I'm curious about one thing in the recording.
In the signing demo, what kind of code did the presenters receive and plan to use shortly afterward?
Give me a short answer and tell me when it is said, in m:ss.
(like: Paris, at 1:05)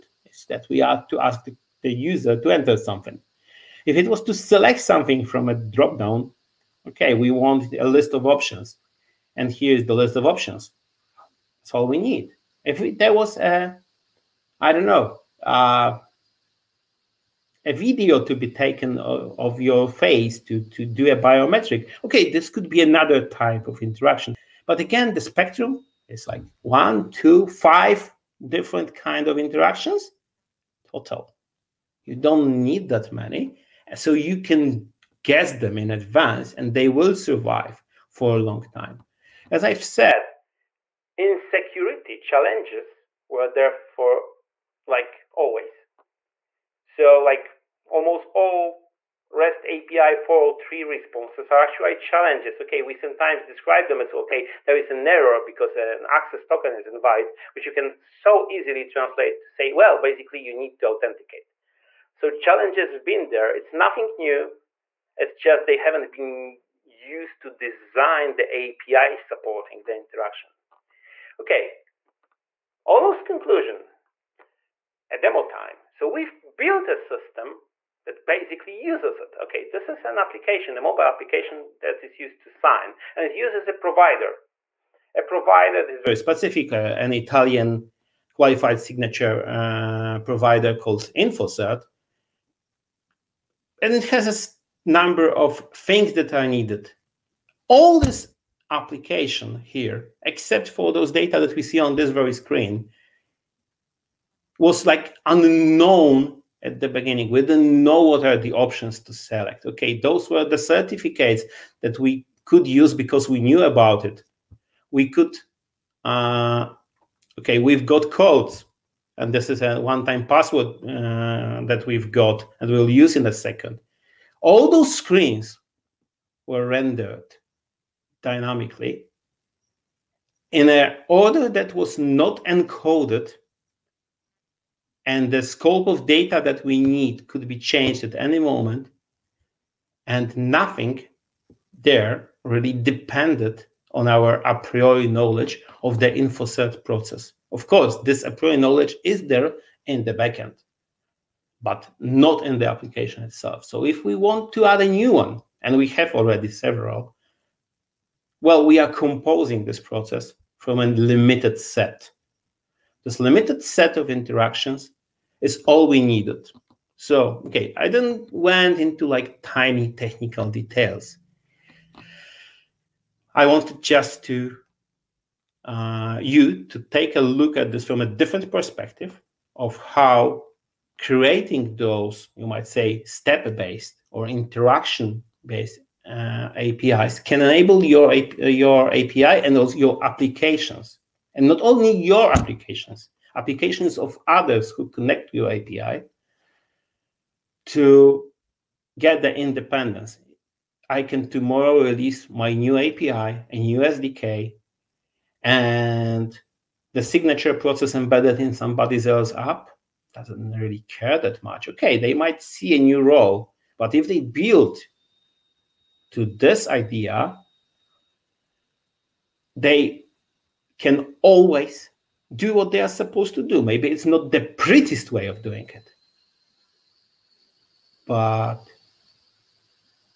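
One-time password, at 1:59.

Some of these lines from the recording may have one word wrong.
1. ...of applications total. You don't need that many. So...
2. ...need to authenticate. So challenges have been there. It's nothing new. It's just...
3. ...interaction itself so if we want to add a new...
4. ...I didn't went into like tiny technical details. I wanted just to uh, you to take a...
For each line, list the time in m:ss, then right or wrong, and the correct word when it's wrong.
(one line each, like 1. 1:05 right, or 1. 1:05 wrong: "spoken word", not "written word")
1. 0:29 wrong: "interactions", not "applications"
2. 1:00 right
3. 2:32 wrong: "application", not "interaction"
4. 2:47 right.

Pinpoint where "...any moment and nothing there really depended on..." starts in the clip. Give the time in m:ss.
2:18.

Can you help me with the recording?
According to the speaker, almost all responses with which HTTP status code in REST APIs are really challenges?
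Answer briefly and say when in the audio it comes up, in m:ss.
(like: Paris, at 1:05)
403, at 0:50.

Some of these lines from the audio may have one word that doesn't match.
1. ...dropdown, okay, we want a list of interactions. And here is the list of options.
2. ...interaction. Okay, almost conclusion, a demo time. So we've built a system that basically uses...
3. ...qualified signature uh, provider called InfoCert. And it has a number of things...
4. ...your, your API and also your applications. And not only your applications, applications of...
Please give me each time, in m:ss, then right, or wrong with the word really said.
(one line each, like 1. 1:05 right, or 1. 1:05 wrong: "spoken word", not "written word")
1. 0:05 wrong: "options", not "interactions"
2. 1:09 right
3. 1:28 right
4. 3:07 right.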